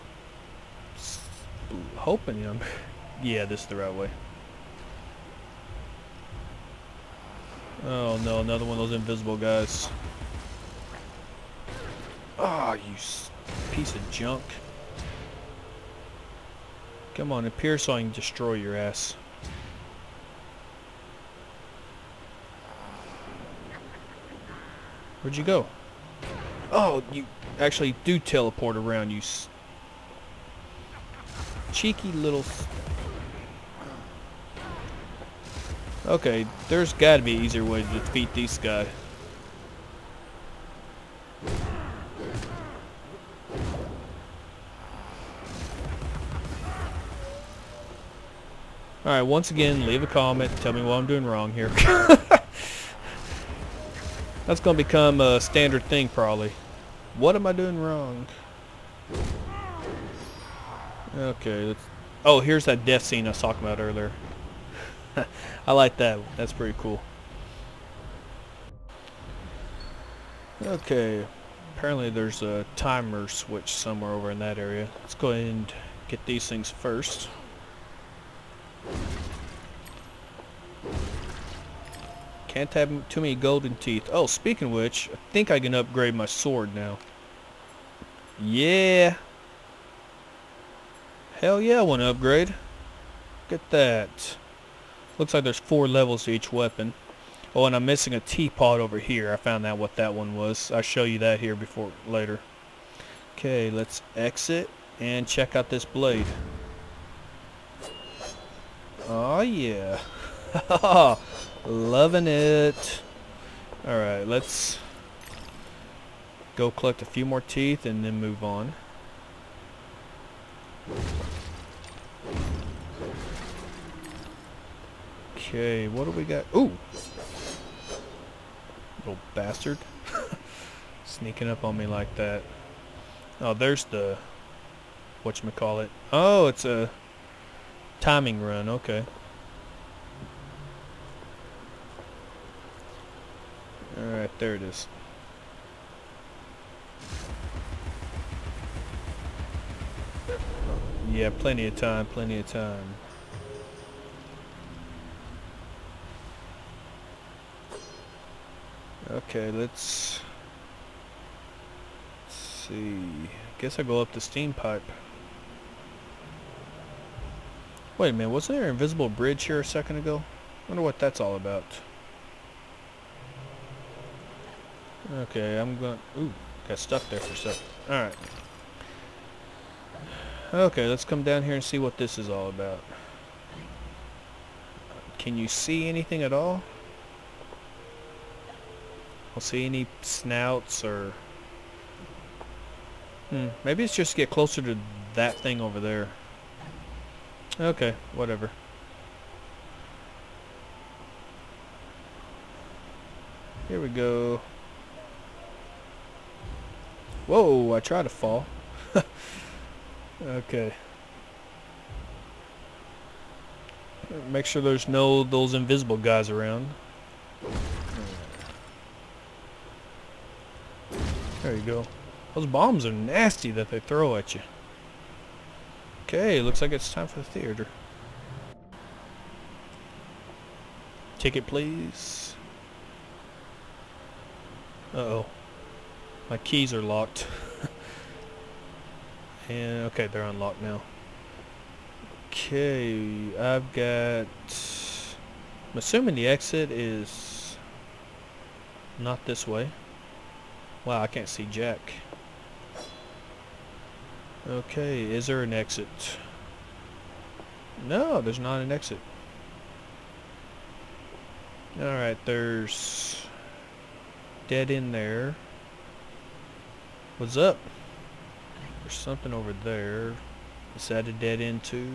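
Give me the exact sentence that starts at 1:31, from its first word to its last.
Hell yeah, I want to upgrade.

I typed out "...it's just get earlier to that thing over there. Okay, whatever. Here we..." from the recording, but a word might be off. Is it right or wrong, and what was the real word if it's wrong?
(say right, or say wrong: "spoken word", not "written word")
wrong: "closer", not "earlier".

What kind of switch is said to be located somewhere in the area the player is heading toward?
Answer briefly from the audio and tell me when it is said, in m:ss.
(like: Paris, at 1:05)
timer switch, at 1:12.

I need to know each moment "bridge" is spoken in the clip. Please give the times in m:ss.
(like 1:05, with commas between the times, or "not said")
2:49.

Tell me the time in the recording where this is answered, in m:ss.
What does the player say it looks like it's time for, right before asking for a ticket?
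3:47.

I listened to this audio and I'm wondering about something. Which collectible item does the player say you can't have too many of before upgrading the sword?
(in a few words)
golden teeth.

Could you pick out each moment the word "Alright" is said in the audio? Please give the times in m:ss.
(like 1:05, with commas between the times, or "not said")
0:49, 1:53, 2:23, 4:21.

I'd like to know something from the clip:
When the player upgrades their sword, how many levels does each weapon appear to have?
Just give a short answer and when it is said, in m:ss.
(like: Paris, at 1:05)
4, at 1:35.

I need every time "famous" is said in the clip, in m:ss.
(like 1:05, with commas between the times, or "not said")
not said.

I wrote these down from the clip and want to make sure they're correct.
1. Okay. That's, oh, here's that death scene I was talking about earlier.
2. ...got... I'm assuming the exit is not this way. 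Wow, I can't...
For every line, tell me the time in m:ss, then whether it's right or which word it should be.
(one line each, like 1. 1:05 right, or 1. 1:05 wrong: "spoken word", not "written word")
1. 1:01 right
2. 4:03 right.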